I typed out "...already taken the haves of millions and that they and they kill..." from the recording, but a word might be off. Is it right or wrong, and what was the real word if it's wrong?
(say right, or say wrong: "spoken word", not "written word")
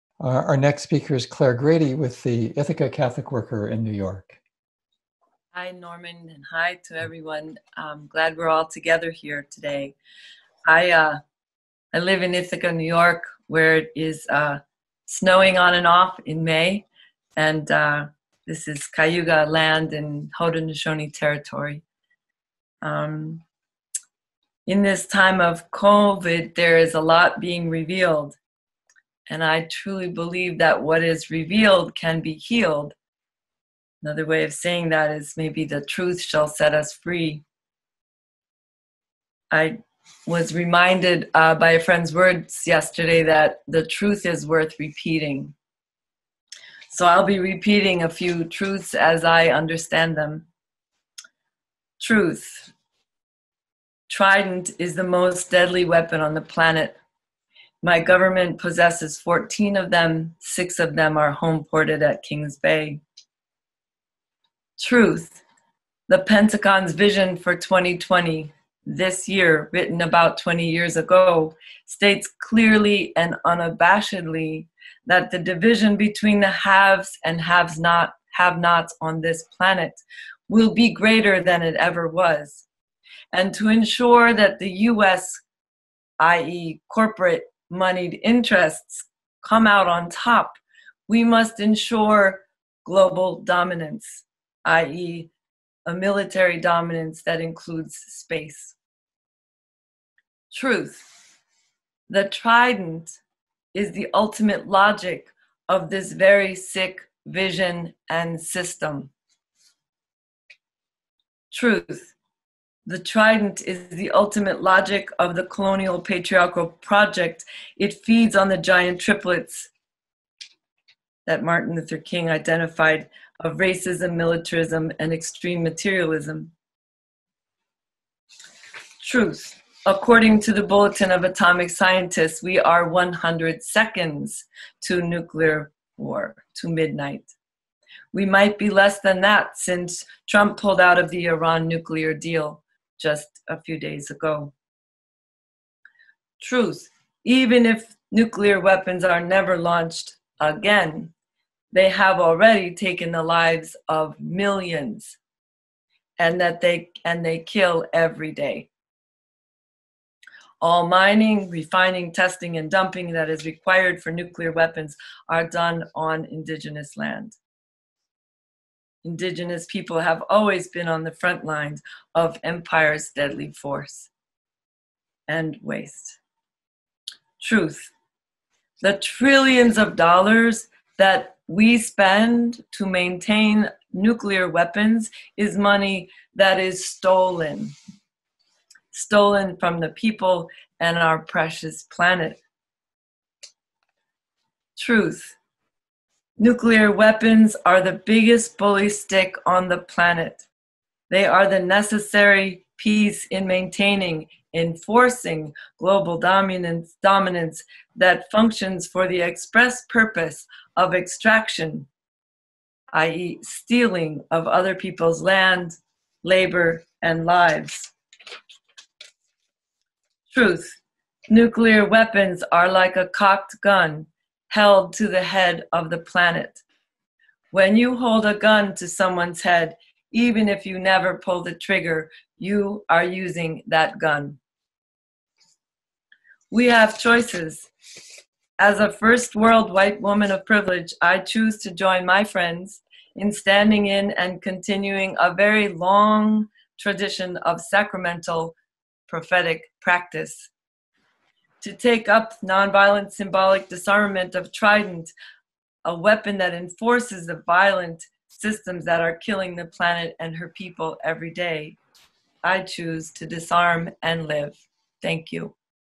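wrong: "lives", not "haves".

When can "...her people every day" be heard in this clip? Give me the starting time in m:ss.
4:20.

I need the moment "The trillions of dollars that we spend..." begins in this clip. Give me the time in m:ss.
2:58.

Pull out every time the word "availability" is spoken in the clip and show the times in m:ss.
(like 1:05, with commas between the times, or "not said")
not said.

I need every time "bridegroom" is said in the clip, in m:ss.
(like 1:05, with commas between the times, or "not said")
not said.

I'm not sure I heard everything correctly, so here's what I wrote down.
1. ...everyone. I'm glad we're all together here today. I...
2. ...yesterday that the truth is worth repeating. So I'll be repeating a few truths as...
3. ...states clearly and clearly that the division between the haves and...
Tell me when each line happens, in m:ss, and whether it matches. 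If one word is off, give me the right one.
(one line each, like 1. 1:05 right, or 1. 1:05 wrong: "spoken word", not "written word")
1. 0:06 right
2. 0:42 right
3. 1:11 wrong: "unabashedly", not "clearly".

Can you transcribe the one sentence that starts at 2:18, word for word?
We might be less than that since Trump pulled out of the Iran nuclear deal just a few days ago.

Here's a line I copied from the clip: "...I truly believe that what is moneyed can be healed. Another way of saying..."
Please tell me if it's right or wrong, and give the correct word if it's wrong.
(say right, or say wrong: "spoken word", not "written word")
wrong: "revealed", not "moneyed".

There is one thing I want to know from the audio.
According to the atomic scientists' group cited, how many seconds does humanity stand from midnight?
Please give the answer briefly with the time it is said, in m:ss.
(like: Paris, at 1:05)
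100, at 2:12.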